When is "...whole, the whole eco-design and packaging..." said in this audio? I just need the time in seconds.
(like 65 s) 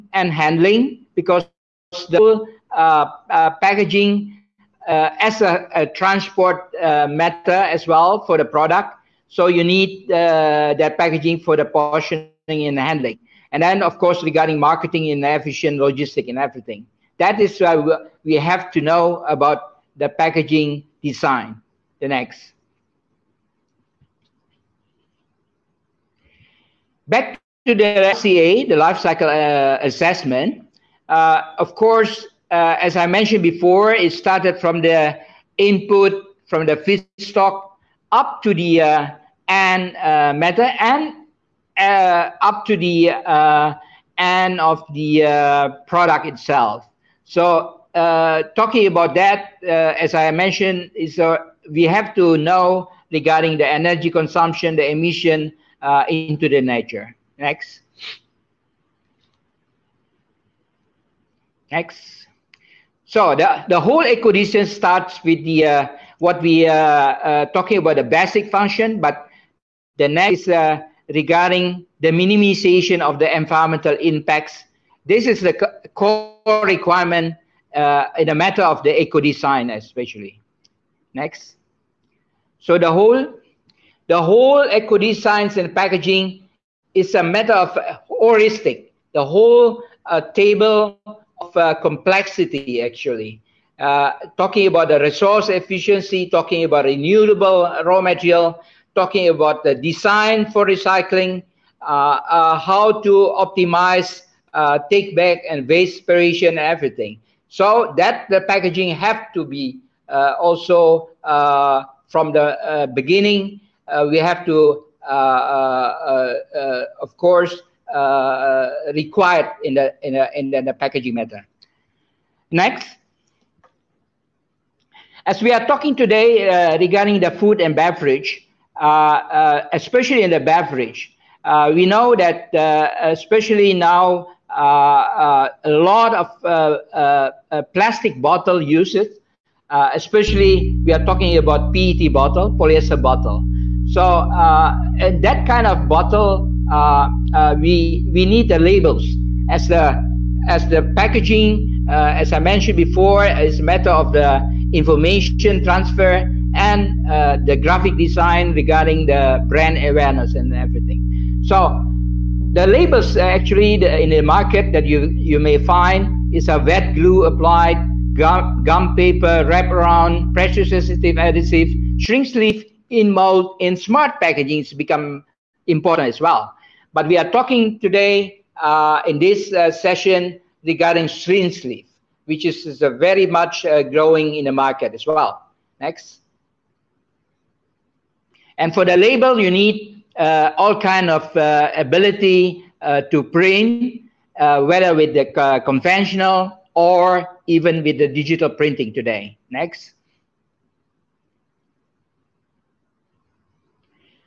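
82 s.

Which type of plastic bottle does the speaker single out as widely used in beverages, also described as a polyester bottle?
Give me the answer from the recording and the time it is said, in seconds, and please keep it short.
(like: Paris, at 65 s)
PET bottle, at 141 s.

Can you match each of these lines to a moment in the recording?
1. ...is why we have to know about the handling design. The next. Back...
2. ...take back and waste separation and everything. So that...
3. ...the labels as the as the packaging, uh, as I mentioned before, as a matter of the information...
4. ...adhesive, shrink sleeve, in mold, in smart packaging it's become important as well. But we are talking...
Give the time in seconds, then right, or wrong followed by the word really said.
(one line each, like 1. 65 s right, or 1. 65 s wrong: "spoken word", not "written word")
1. 17 s wrong: "packaging", not "handling"
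2. 104 s right
3. 148 s right
4. 171 s right.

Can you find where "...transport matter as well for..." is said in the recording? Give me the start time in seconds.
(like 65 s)
5 s.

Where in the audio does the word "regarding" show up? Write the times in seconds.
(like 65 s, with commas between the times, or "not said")
14 s, 53 s, 71 s, 126 s, 158 s, 180 s.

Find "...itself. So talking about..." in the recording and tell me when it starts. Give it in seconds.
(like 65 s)
46 s.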